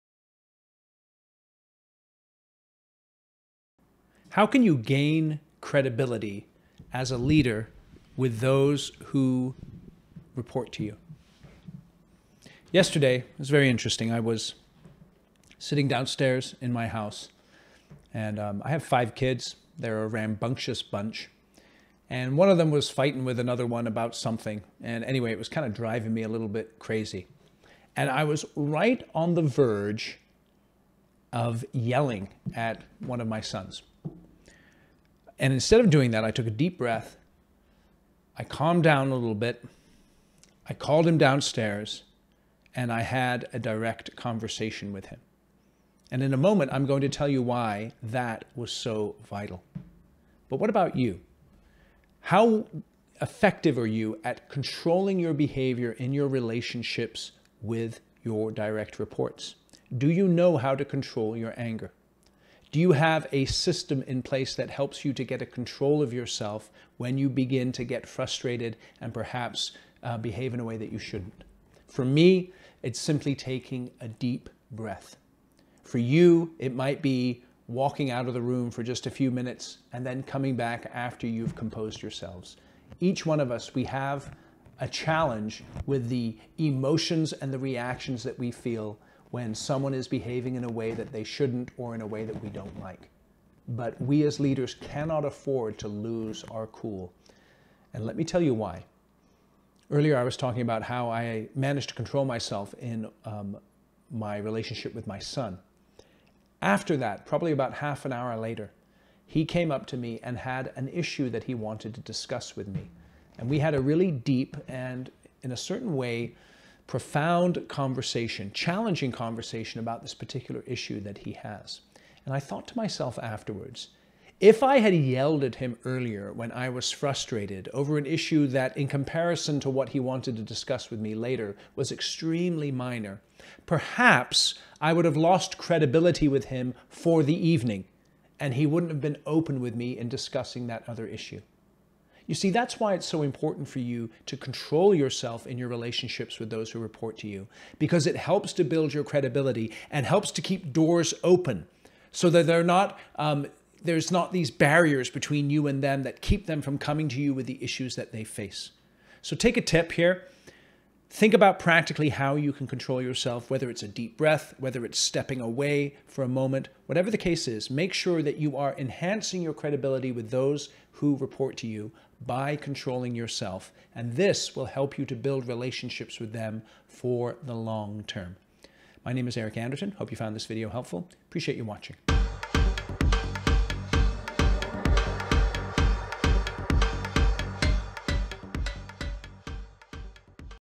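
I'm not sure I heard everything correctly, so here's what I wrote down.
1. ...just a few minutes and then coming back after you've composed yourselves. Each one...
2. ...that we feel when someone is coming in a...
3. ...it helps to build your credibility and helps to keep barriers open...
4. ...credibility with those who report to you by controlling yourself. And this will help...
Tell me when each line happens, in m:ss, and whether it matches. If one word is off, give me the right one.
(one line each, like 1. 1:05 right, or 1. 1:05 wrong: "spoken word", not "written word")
1. 1:18 right
2. 1:28 wrong: "behaving", not "coming"
3. 2:28 wrong: "doors", not "barriers"
4. 2:49 right.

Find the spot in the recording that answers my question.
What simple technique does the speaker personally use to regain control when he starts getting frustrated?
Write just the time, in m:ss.
1:13.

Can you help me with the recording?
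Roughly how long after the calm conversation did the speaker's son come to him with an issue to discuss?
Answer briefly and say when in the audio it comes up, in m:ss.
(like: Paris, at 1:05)
Half an hour, at 1:47.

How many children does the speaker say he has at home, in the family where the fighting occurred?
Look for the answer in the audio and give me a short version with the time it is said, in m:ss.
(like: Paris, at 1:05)
5, at 0:18.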